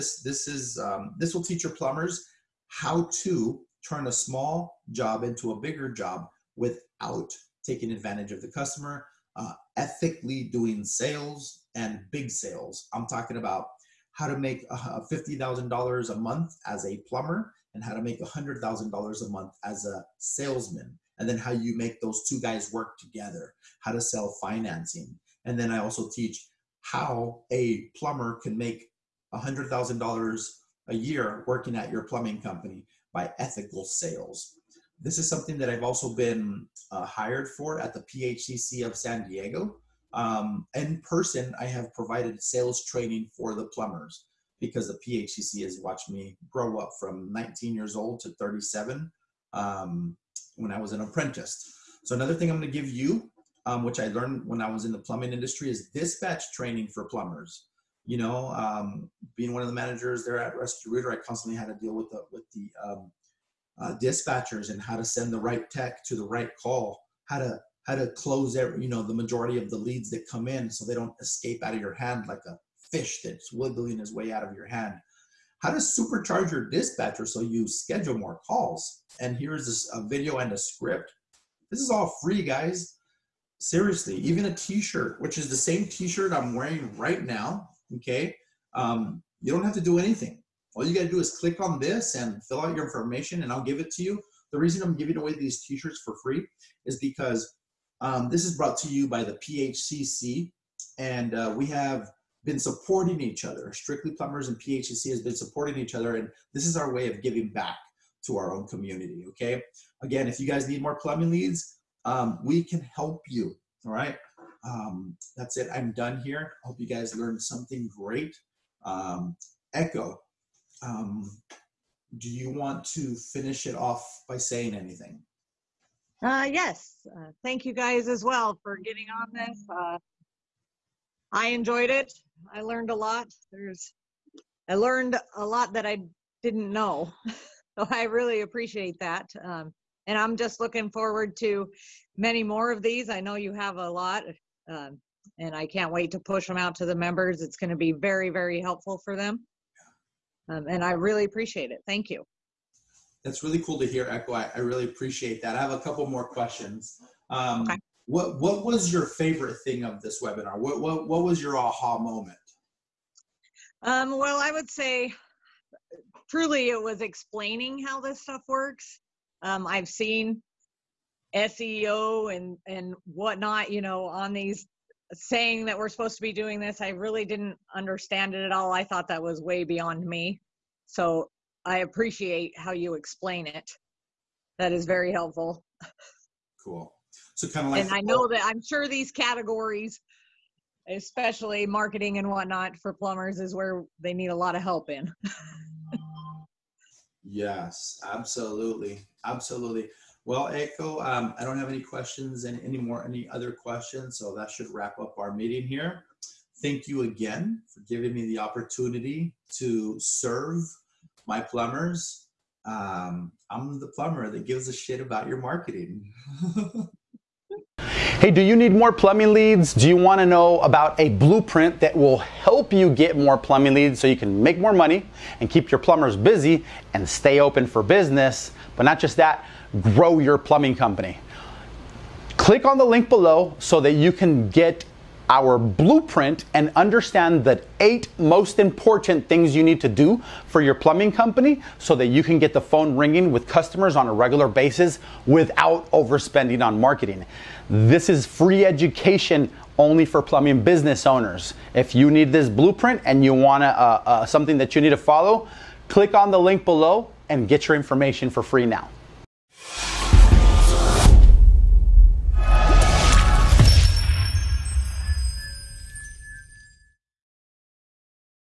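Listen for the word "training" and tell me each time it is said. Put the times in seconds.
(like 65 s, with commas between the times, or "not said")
42 s, 56 s.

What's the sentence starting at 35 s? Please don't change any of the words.
This is something that I've also been uh, hired for at the PHCC of San Diego.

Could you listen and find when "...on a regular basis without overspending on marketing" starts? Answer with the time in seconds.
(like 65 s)
243 s.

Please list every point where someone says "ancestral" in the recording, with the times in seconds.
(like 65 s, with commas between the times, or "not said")
not said.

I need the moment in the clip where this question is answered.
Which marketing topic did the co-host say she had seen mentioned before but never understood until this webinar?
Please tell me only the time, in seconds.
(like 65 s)
171 s.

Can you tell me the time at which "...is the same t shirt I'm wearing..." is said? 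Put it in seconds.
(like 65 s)
85 s.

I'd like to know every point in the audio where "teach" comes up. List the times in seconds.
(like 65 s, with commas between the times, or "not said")
1 s, 26 s.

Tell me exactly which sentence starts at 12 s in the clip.
I'm talking about how to make $50,000 a month as a plumber and how to make $100,000 a month as a salesman.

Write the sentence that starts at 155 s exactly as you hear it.
I have a couple more questions.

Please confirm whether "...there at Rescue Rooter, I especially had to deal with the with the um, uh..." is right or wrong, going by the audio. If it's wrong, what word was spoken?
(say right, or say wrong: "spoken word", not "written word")
wrong: "constantly", not "especially".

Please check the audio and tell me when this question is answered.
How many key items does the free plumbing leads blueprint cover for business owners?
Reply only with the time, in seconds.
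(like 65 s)
237 s.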